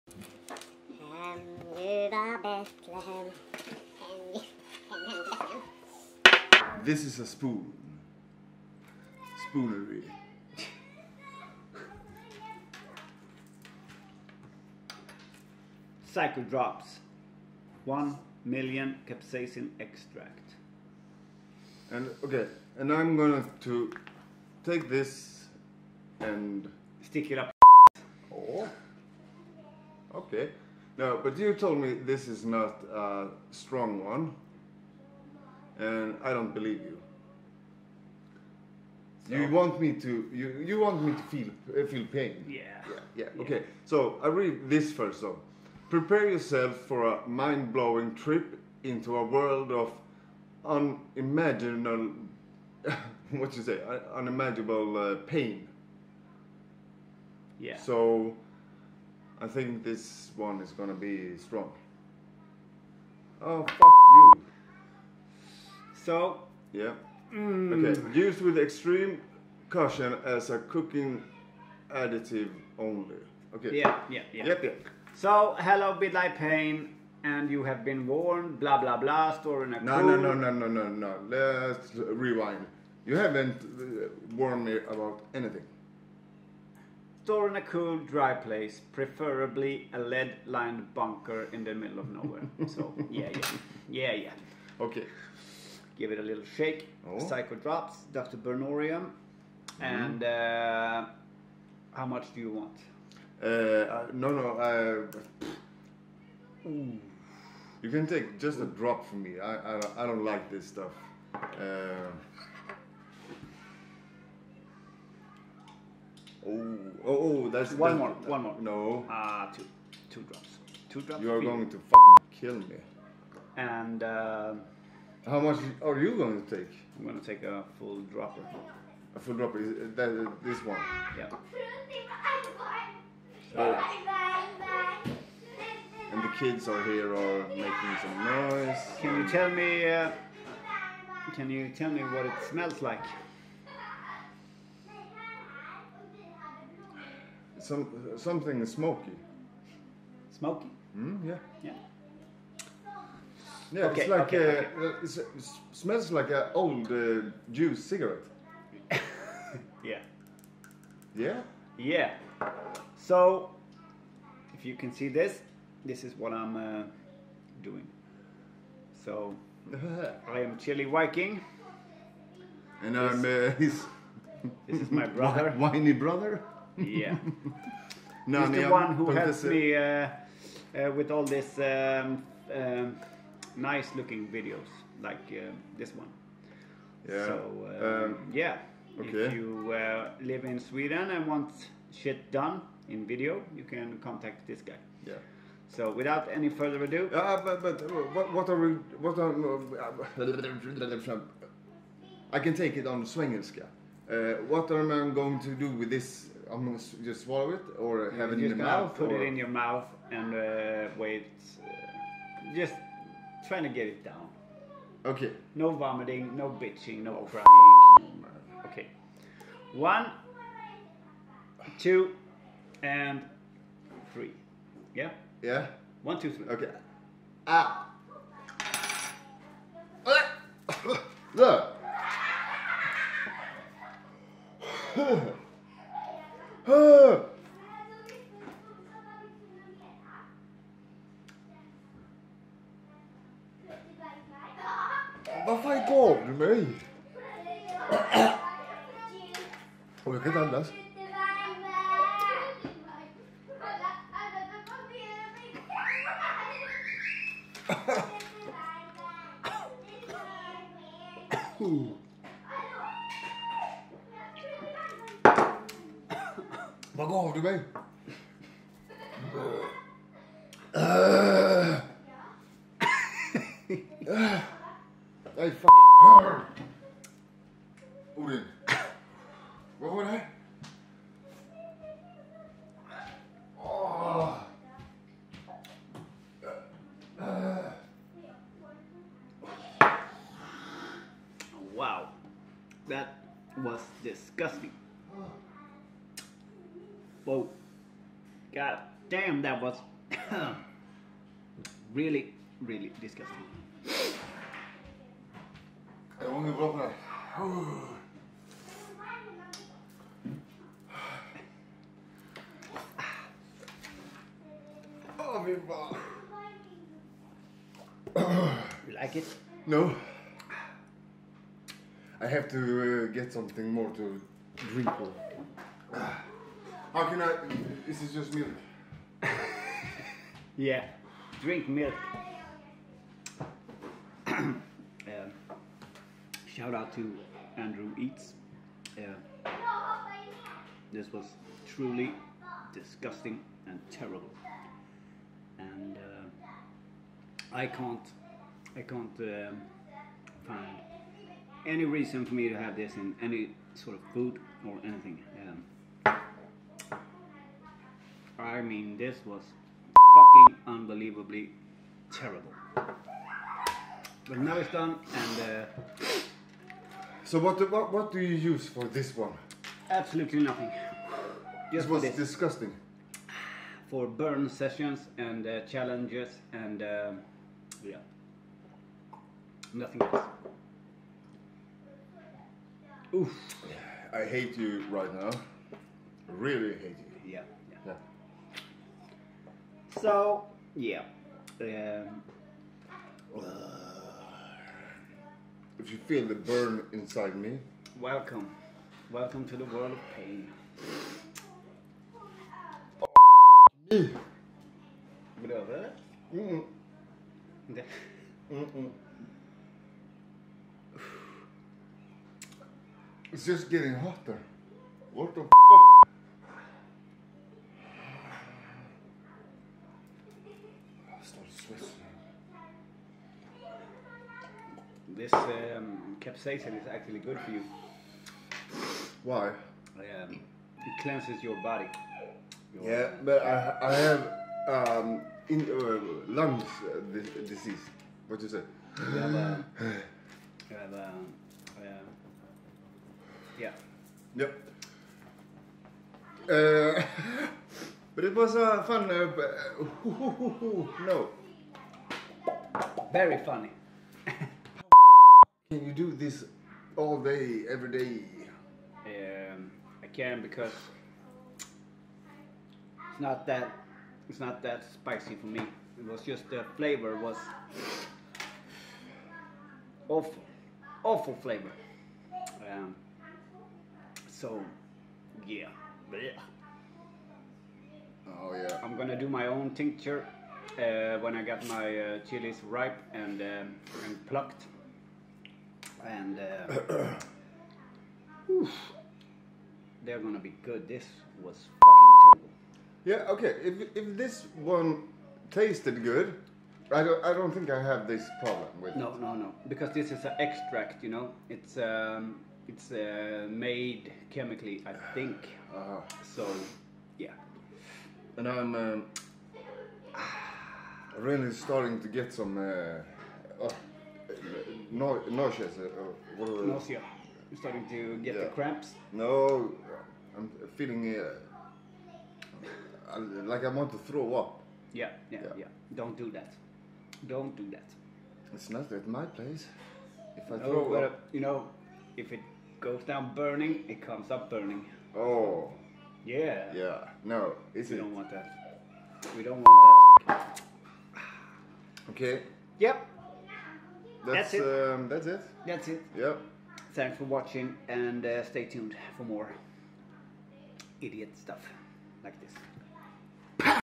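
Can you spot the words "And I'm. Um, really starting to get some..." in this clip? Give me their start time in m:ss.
8:28.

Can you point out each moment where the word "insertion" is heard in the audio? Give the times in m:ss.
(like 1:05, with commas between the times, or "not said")
not said.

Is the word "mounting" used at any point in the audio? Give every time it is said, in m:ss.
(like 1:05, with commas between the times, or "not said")
not said.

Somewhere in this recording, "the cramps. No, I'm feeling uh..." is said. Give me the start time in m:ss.
8:38.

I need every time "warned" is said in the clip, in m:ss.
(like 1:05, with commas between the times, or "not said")
1:18, 1:24.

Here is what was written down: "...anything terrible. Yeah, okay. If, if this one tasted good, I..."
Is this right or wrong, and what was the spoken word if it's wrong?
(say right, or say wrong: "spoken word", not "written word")
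wrong: "fucking", not "anything".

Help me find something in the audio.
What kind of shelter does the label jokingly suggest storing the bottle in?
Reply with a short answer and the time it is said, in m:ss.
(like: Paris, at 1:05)
lead-lined bunker, at 1:29.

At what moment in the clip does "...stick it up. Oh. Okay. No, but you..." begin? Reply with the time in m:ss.
0:27.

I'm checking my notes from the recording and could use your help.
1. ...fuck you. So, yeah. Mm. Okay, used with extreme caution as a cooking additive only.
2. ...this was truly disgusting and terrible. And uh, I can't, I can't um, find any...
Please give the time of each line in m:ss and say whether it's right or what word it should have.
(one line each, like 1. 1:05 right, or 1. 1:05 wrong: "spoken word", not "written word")
1. 1:03 right
2. 5:40 right.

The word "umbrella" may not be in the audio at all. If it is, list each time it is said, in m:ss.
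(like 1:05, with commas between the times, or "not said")
not said.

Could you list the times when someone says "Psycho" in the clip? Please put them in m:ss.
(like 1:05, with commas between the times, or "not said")
0:16, 1:37.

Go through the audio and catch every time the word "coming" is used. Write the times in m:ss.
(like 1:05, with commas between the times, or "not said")
not said.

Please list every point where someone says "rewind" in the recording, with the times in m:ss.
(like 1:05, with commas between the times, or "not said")
1:21.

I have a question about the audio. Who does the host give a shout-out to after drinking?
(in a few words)
Andrew Eats.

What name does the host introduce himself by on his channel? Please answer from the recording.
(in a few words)
Chili Viking.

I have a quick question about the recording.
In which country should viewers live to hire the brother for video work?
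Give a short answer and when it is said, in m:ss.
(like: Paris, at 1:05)
Sweden, at 3:10.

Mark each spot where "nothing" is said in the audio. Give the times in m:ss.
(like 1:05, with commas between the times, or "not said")
6:10, 6:19.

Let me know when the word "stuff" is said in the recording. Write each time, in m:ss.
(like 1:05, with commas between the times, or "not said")
1:50, 9:11.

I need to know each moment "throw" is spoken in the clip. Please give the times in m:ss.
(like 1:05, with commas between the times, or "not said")
8:44, 8:50.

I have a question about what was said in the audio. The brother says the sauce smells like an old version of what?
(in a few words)
juice cigarette.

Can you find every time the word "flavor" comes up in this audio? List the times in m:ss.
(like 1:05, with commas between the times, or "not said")
7:46, 7:51.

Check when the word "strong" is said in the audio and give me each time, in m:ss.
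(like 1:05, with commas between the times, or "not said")
0:33, 1:01.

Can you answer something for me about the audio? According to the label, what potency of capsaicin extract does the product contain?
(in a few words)
One million.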